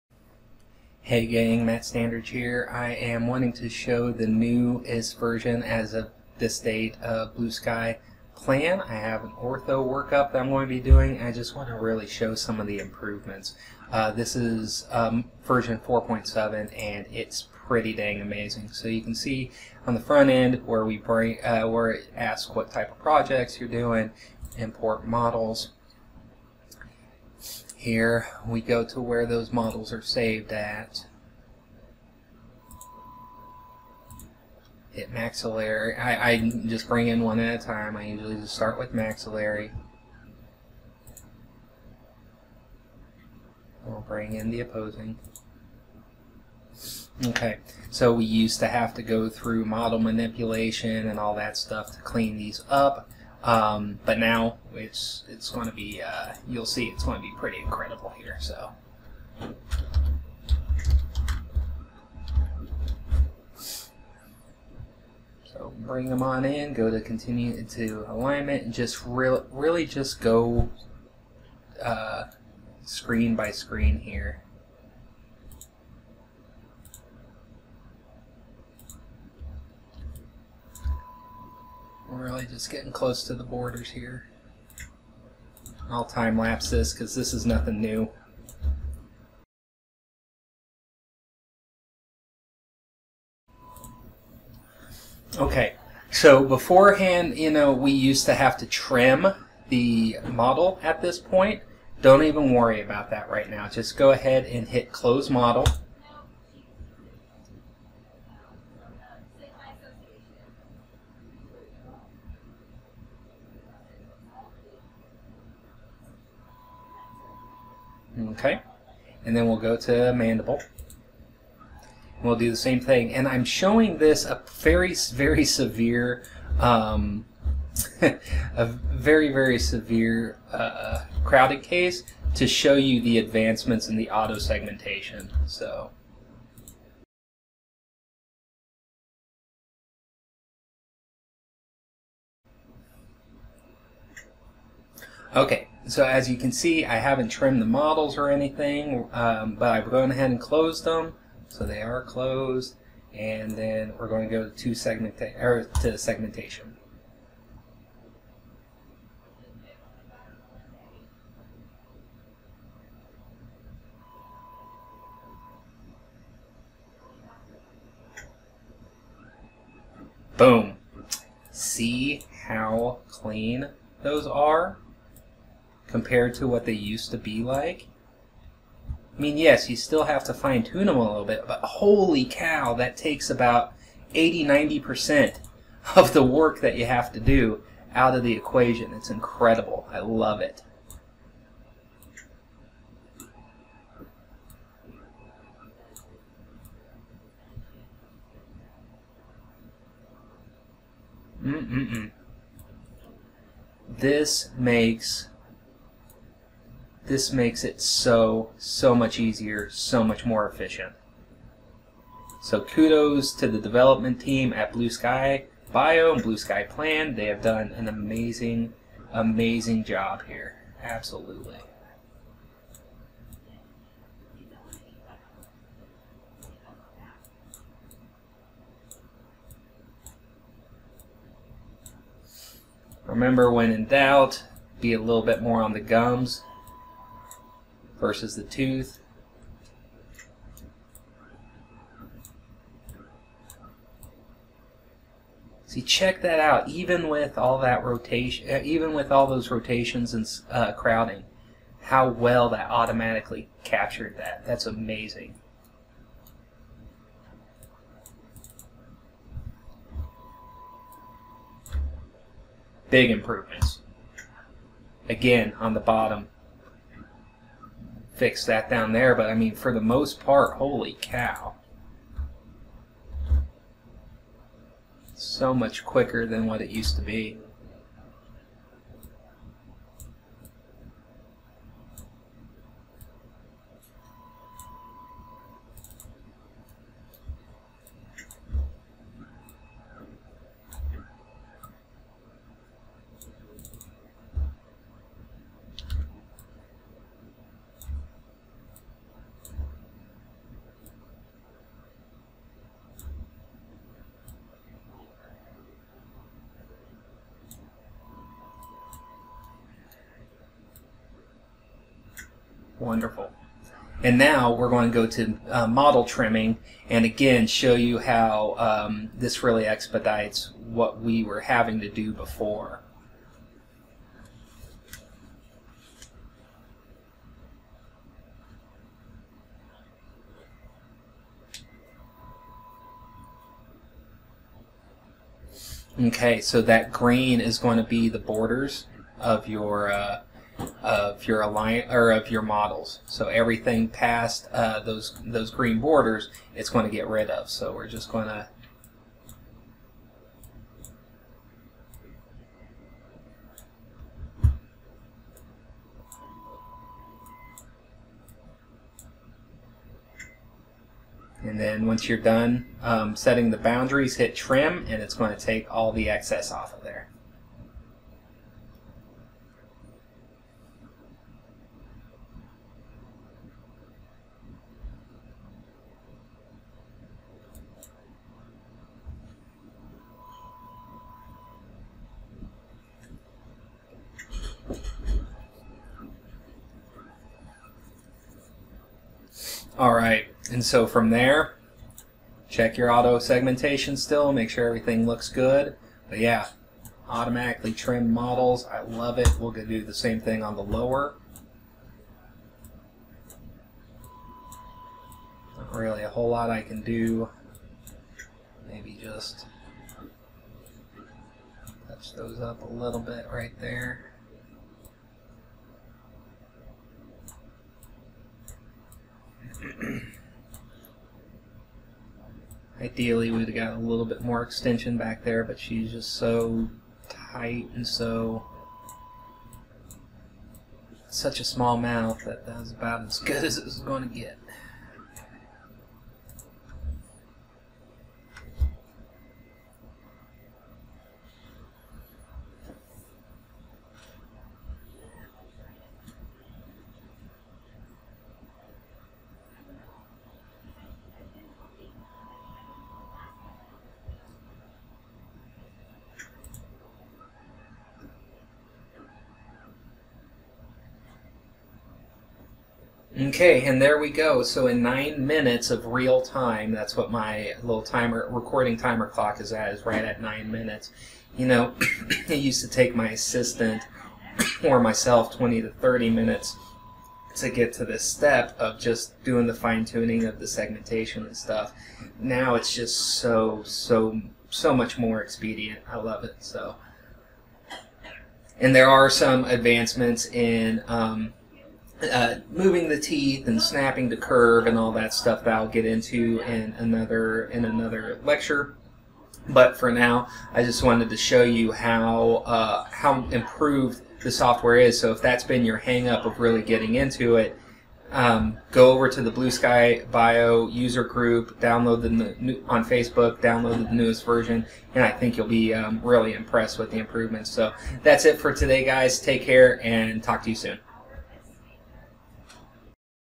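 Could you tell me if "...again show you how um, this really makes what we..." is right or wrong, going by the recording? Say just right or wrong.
wrong.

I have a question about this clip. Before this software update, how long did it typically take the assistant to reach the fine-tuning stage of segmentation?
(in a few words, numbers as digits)
20 to 30 minutes.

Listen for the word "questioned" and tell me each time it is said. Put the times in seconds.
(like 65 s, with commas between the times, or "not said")
not said.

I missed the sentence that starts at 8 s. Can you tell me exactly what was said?
I have an ortho workup that I'm going to be doing.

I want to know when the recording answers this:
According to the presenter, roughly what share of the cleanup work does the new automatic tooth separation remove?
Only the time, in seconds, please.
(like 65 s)
184 s.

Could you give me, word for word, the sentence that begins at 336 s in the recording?
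Okay, so that green is going to be the borders of your uh, of your aligners or of your models.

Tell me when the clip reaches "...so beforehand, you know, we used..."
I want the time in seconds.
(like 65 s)
96 s.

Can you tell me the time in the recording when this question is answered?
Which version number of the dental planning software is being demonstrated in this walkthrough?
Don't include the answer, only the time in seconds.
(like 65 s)
15 s.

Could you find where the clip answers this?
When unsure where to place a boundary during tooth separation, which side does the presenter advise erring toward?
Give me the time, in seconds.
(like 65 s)
235 s.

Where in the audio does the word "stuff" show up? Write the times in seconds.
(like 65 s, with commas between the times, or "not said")
51 s, 481 s, 495 s.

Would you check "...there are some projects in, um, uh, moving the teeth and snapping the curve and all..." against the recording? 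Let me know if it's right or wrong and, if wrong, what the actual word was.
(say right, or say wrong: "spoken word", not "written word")
wrong: "advancements", not "projects".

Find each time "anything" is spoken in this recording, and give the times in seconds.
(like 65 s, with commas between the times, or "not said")
148 s.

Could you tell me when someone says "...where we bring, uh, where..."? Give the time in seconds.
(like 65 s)
20 s.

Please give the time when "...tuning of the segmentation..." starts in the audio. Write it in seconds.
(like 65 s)
479 s.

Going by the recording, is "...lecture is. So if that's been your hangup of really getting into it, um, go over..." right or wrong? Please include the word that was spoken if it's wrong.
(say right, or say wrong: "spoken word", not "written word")
wrong: "software", not "lecture".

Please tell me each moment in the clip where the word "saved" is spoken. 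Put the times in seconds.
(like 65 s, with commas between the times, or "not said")
30 s.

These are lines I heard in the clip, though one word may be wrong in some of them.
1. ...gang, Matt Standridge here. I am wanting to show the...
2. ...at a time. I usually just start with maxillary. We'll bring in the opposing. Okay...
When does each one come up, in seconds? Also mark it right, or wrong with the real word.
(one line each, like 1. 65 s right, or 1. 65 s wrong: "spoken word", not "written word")
1. 1 s right
2. 37 s right.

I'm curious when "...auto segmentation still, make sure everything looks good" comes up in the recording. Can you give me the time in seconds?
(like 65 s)
392 s.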